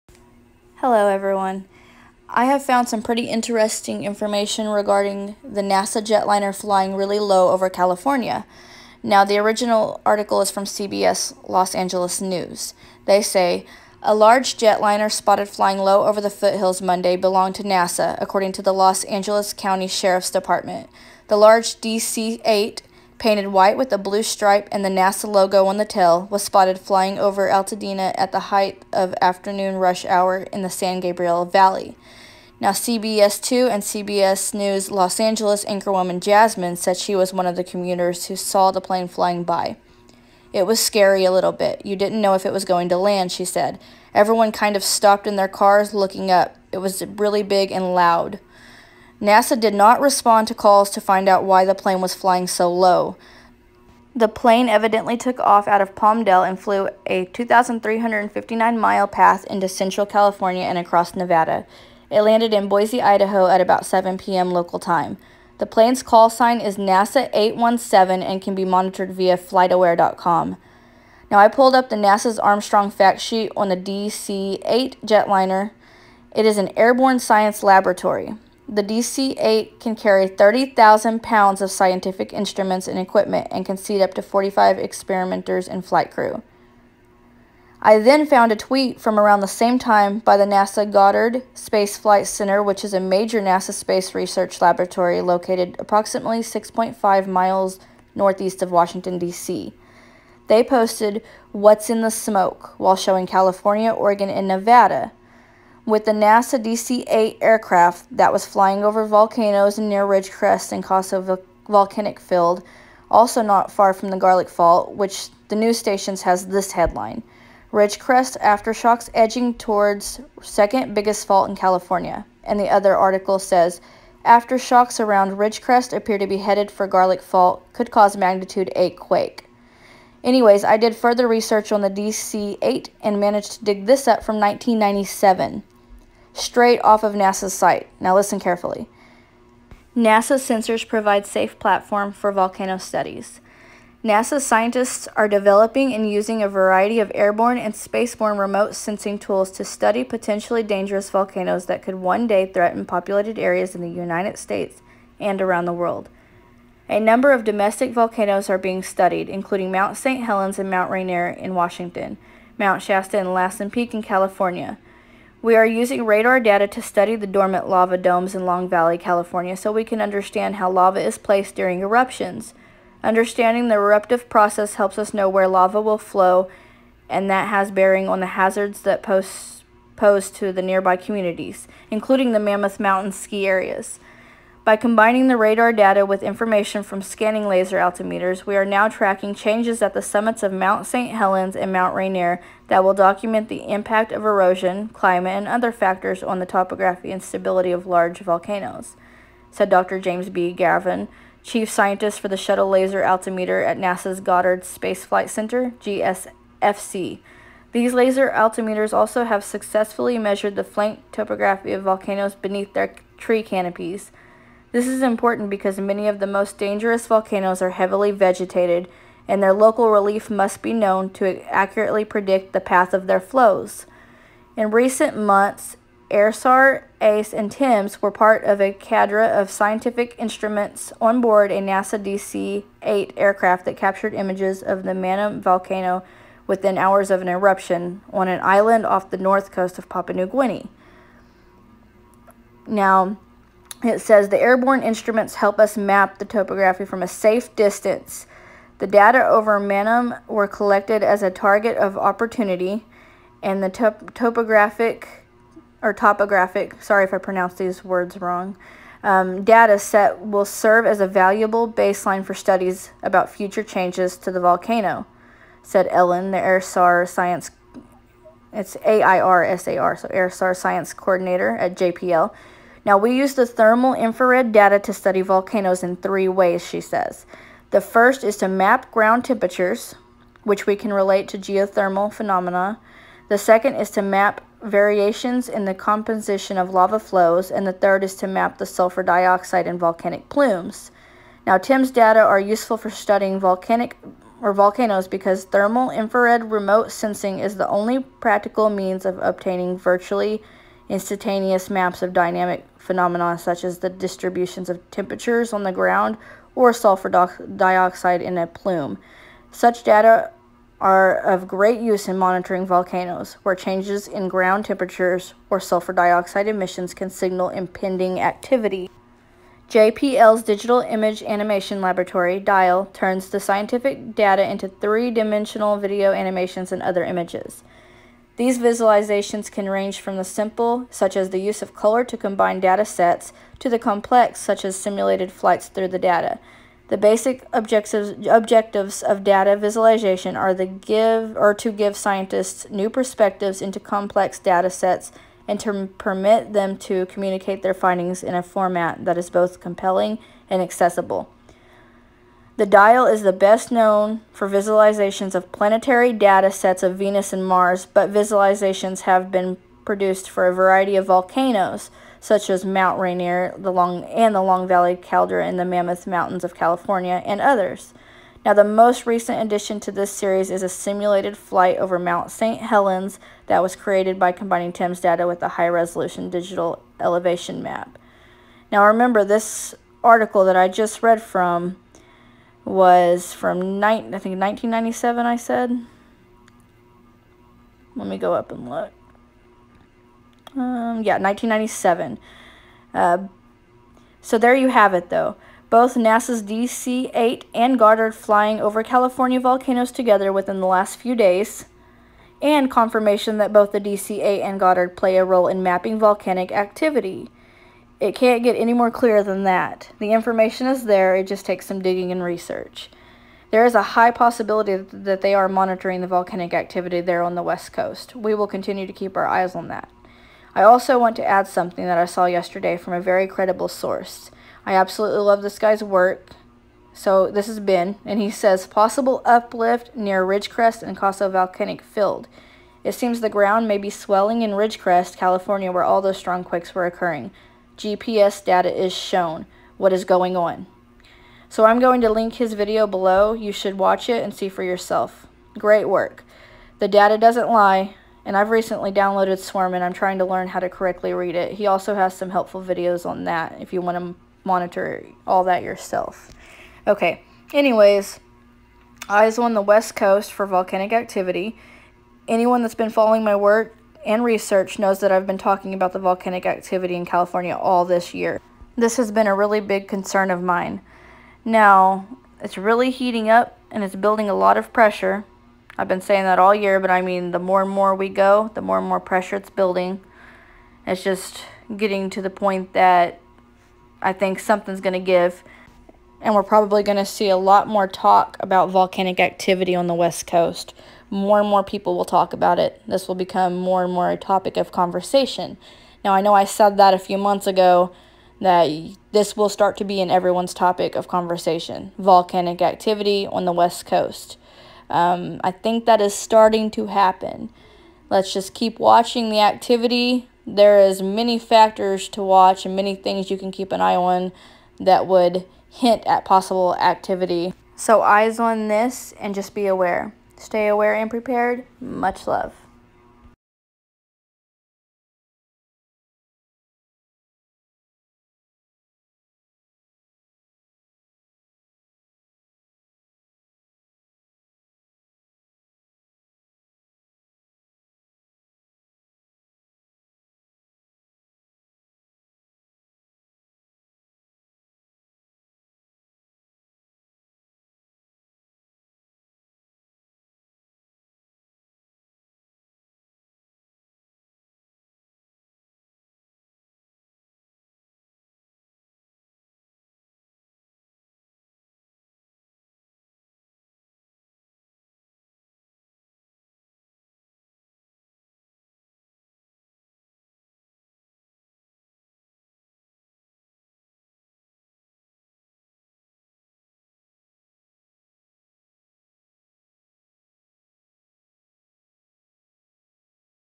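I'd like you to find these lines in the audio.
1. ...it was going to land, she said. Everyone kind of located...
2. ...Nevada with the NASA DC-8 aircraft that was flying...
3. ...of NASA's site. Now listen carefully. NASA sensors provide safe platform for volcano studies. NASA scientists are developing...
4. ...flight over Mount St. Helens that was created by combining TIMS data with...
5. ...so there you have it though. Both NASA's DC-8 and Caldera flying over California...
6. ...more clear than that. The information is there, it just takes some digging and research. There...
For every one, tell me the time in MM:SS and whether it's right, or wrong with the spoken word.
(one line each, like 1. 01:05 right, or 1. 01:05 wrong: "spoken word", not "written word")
1. 00:42 wrong: "stopped", not "located"
2. 01:44 right
3. 02:17 right
4. 06:11 right
5. 06:34 wrong: "Goddard", not "Caldera"
6. 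06:48 right.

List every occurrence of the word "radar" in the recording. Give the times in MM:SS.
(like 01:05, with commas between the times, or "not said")
02:46, 03:05.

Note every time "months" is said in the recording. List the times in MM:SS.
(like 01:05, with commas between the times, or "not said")
03:45, 08:17.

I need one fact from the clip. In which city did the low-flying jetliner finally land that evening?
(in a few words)
Boise, Idaho.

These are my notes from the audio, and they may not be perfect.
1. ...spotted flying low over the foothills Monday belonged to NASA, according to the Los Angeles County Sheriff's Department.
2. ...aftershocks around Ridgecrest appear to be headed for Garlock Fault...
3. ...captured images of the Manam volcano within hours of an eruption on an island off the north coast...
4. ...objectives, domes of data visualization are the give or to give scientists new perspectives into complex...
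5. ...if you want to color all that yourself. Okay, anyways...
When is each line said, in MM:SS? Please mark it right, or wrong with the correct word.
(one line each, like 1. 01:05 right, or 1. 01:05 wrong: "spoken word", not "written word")
1. 00:15 right
2. 02:04 right
3. 03:53 right
4. 05:37 wrong: "objectives", not "domes"
5. 07:33 wrong: "monitor", not "color".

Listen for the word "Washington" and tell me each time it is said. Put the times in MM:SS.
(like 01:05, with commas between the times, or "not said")
01:38, 02:41.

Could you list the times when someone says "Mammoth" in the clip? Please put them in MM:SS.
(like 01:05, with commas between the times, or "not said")
03:02, 06:05.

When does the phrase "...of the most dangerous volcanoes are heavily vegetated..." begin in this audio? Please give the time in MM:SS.
03:36.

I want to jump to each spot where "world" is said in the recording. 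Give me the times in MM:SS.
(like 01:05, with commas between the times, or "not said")
02:35.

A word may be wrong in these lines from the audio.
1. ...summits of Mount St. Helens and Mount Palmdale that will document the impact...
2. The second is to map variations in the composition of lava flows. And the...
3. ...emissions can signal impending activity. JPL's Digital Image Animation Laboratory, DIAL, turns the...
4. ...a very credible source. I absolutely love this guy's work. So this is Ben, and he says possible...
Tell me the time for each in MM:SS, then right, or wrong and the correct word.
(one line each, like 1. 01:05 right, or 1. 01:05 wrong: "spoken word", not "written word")
1. 03:10 wrong: "Rainier", not "Palmdale"
2. 04:43 right
3. 05:16 right
4. 07:02 right.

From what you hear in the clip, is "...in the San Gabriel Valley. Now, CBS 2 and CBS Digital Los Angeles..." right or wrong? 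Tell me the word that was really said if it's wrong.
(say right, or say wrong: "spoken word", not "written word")
wrong: "News", not "Digital".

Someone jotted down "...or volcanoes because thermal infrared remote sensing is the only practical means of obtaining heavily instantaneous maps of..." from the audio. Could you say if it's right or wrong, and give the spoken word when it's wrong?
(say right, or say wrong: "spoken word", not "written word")
wrong: "virtually", not "heavily".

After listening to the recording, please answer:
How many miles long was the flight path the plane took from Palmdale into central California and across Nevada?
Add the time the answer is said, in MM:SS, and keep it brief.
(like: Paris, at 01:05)
2,359, at 00:57.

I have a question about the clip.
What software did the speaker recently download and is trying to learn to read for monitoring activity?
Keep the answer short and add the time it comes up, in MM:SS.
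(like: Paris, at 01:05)
Swarm, at 07:29.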